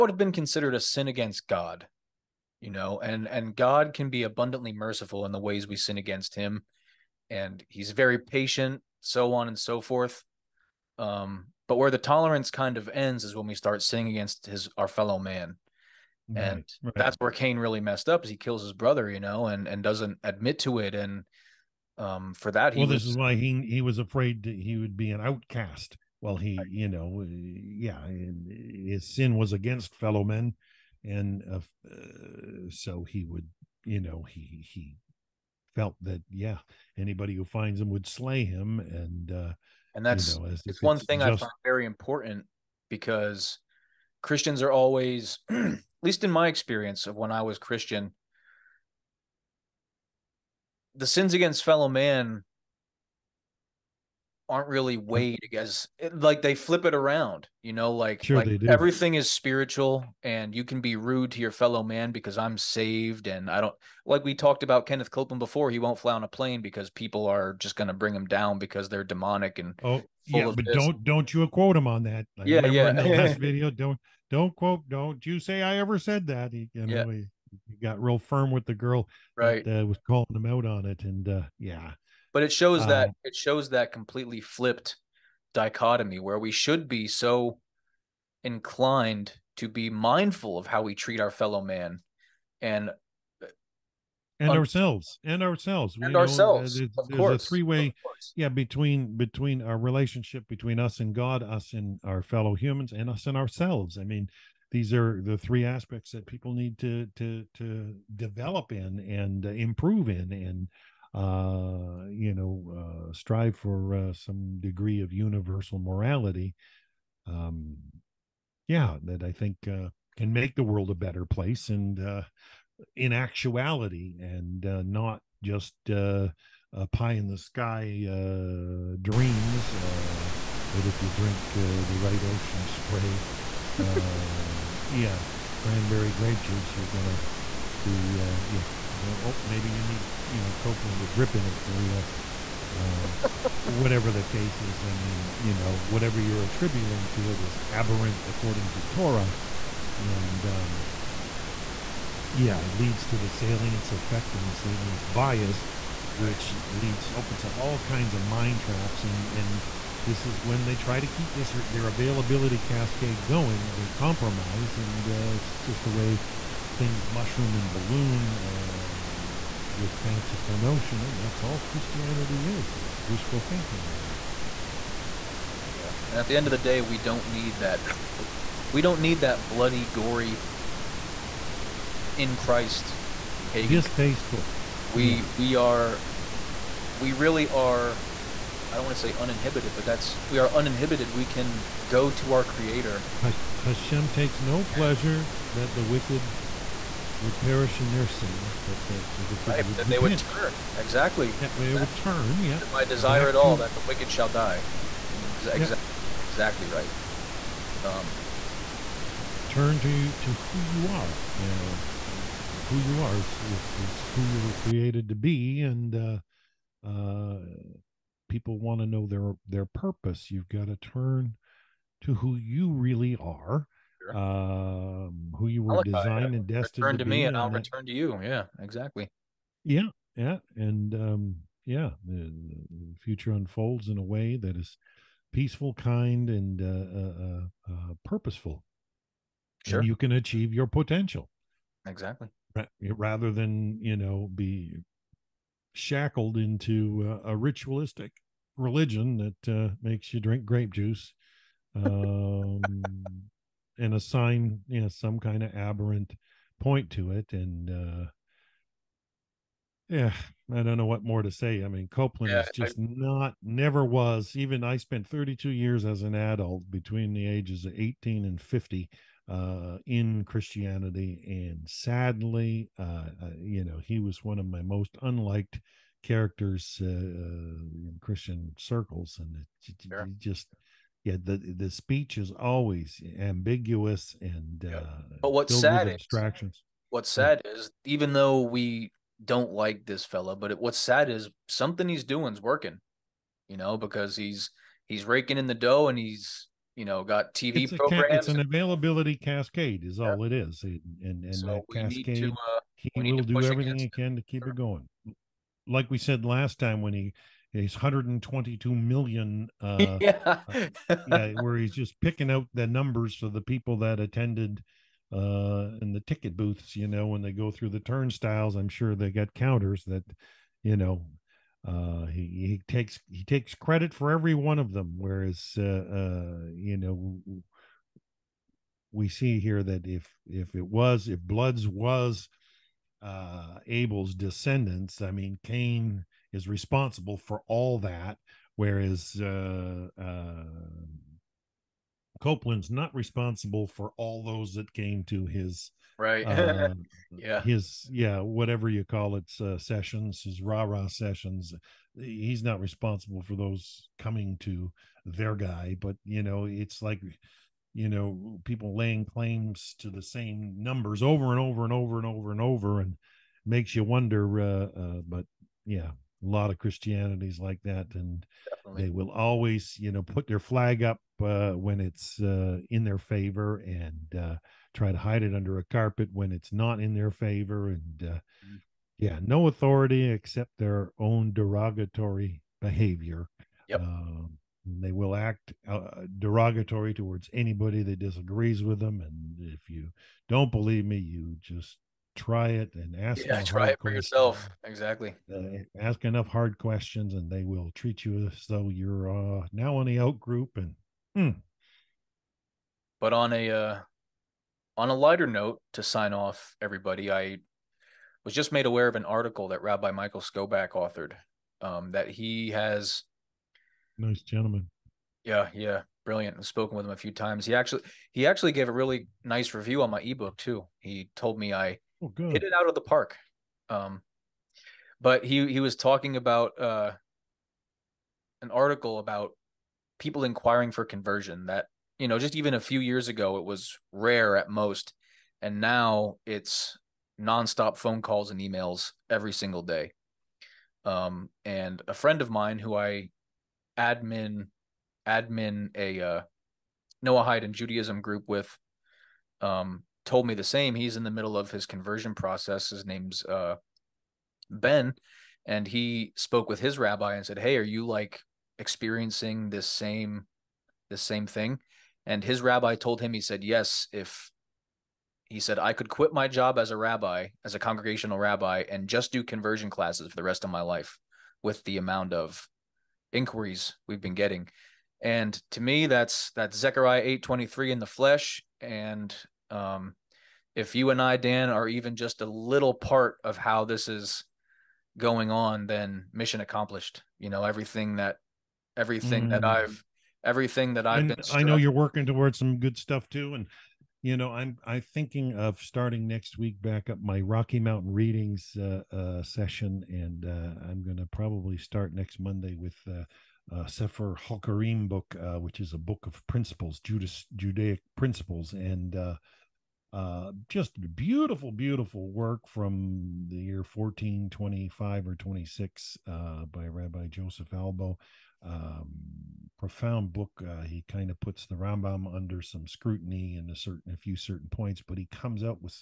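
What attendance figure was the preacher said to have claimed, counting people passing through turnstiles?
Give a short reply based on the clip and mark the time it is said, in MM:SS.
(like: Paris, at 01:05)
122 million, at 05:07.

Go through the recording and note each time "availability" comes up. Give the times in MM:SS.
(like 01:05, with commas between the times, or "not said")
02:41, 04:58.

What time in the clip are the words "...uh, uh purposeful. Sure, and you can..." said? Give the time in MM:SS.
03:57.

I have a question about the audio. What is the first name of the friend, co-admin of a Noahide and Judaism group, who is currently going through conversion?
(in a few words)
Ben.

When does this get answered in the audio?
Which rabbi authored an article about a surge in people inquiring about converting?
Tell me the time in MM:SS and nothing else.
06:49.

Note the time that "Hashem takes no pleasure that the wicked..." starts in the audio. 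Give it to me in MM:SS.
03:13.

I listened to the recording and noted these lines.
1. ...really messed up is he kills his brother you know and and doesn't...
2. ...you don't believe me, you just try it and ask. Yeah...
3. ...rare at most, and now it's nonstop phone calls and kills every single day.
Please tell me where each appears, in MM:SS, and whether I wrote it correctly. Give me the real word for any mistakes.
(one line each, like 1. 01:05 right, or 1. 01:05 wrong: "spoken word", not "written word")
1. 00:17 right
2. 06:29 right
3. 07:13 wrong: "emails", not "kills".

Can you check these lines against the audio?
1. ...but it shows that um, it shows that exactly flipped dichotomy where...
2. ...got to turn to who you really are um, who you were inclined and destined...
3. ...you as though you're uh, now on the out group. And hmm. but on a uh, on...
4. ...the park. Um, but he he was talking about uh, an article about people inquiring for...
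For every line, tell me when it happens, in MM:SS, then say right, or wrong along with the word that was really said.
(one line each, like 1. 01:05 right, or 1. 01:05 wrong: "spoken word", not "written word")
1. 01:22 wrong: "completely", not "exactly"
2. 03:40 wrong: "designed", not "inclined"
3. 06:38 right
4. 07:02 right.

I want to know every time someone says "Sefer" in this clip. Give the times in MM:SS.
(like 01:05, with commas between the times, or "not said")
08:23.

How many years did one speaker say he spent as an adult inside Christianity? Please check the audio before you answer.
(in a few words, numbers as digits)
32.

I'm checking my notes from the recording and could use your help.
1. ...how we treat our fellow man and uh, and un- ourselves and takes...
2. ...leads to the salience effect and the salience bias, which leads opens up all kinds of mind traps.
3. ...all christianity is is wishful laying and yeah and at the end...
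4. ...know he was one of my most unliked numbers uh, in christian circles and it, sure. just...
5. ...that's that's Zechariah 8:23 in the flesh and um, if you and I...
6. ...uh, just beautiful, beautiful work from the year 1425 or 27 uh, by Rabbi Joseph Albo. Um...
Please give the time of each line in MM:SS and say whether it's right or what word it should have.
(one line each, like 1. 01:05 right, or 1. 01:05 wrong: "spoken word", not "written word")
1. 01:30 wrong: "ourselves", not "takes"
2. 02:32 right
3. 02:51 wrong: "thinking", not "laying"
4. 04:33 wrong: "characters", not "numbers"
5. 07:55 right
6. 08:29 wrong: "26", not "27".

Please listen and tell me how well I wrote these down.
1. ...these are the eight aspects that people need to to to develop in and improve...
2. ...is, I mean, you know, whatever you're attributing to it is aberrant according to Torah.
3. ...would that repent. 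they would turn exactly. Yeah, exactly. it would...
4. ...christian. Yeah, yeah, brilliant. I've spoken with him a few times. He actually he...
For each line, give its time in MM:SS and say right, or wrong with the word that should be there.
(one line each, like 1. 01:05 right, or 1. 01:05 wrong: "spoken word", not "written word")
1. 01:44 wrong: "three", not "eight"
2. 02:24 right
3. 03:19 right
4. 06:54 wrong: "gentleman", not "christian".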